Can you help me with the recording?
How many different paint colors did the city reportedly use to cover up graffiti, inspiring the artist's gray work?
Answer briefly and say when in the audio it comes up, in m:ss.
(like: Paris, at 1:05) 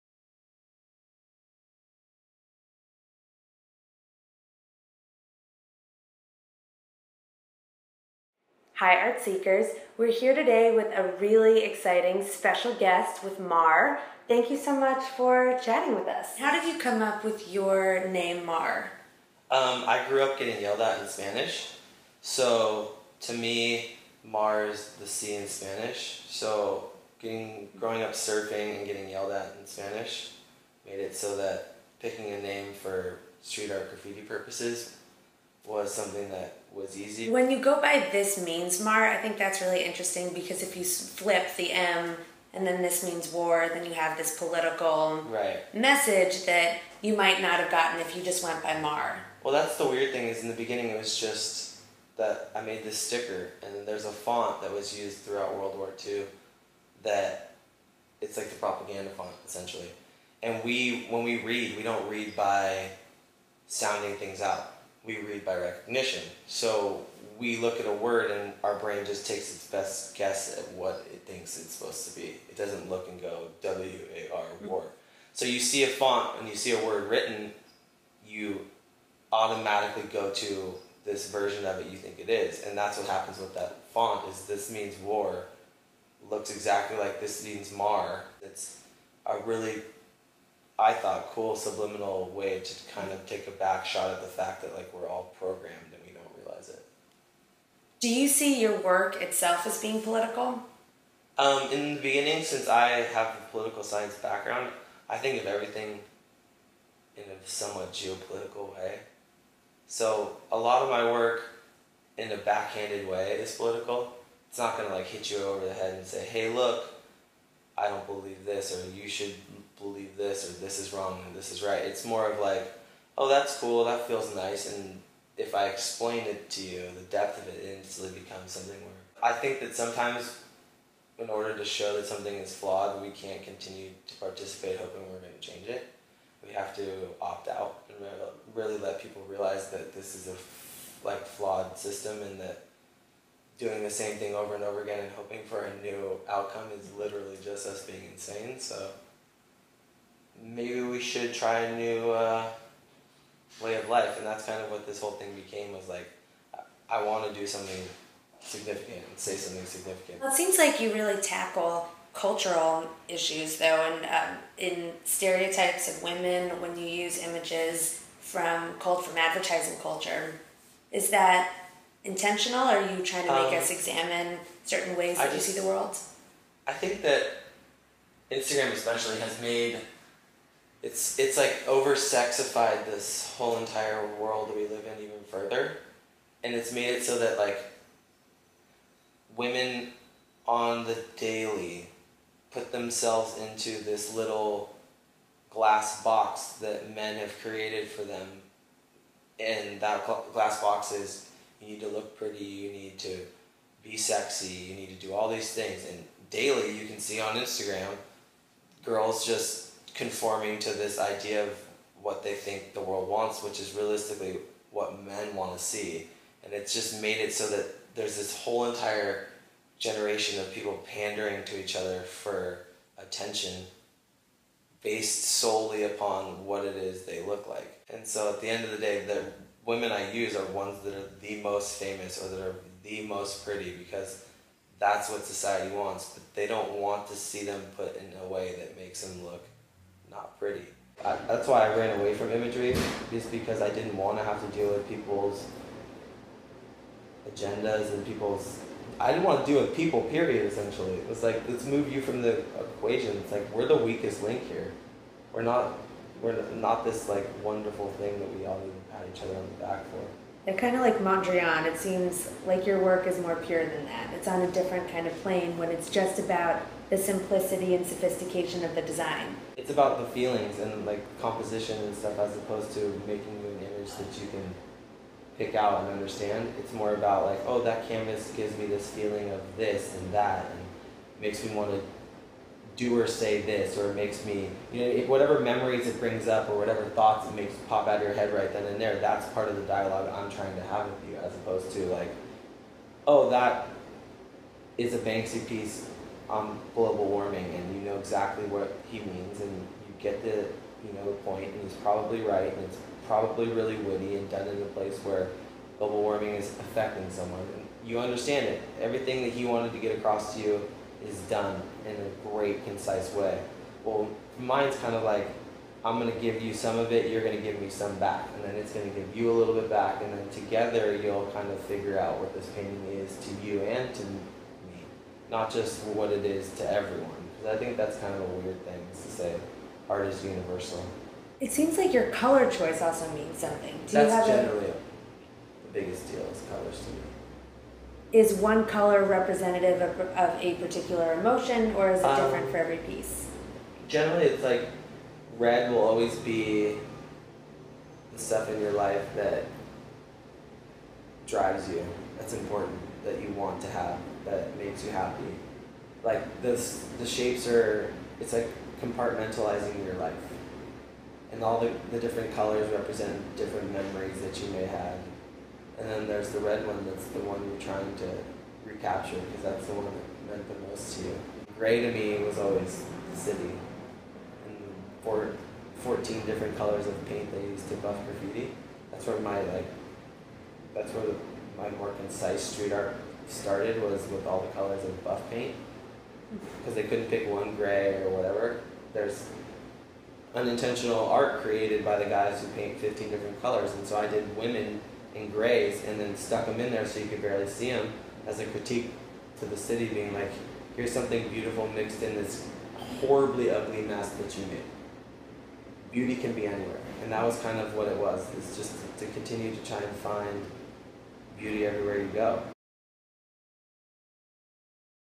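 14, at 6:15.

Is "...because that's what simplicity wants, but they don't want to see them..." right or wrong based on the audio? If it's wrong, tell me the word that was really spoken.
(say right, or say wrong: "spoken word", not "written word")
wrong: "society", not "simplicity".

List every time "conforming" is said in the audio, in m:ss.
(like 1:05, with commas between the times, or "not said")
3:30.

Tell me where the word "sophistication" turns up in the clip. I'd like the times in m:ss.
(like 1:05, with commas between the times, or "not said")
4:27.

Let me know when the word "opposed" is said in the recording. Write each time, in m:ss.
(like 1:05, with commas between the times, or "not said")
4:32, 4:51.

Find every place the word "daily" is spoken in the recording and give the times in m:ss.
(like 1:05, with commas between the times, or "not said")
3:11, 3:26.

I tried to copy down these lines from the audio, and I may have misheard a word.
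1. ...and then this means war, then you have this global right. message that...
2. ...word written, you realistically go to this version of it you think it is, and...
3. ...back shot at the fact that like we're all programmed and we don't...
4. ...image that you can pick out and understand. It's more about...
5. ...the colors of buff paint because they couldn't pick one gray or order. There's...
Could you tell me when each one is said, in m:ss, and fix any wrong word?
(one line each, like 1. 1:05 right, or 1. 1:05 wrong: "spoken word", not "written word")
1. 0:42 wrong: "political", not "global"
2. 1:16 wrong: "automatically", not "realistically"
3. 1:33 right
4. 4:33 right
5. 6:24 wrong: "whatever", not "order".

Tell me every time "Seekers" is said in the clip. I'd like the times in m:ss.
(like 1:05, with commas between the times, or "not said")
0:09.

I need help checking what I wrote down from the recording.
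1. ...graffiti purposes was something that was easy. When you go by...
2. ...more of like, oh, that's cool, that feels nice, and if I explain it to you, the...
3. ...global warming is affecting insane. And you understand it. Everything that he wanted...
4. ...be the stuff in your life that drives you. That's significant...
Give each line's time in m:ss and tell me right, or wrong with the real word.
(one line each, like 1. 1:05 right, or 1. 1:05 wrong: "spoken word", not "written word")
1. 0:33 right
2. 2:02 right
3. 5:05 wrong: "someone", not "insane"
4. 5:46 wrong: "important", not "significant".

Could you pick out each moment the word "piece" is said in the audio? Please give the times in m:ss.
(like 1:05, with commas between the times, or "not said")
4:55, 5:42.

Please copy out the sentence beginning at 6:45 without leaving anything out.
Beauty can be anywhere, and that was kind of what it was.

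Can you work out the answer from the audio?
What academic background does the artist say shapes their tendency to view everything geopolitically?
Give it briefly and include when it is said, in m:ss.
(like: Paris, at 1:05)
political science, at 1:43.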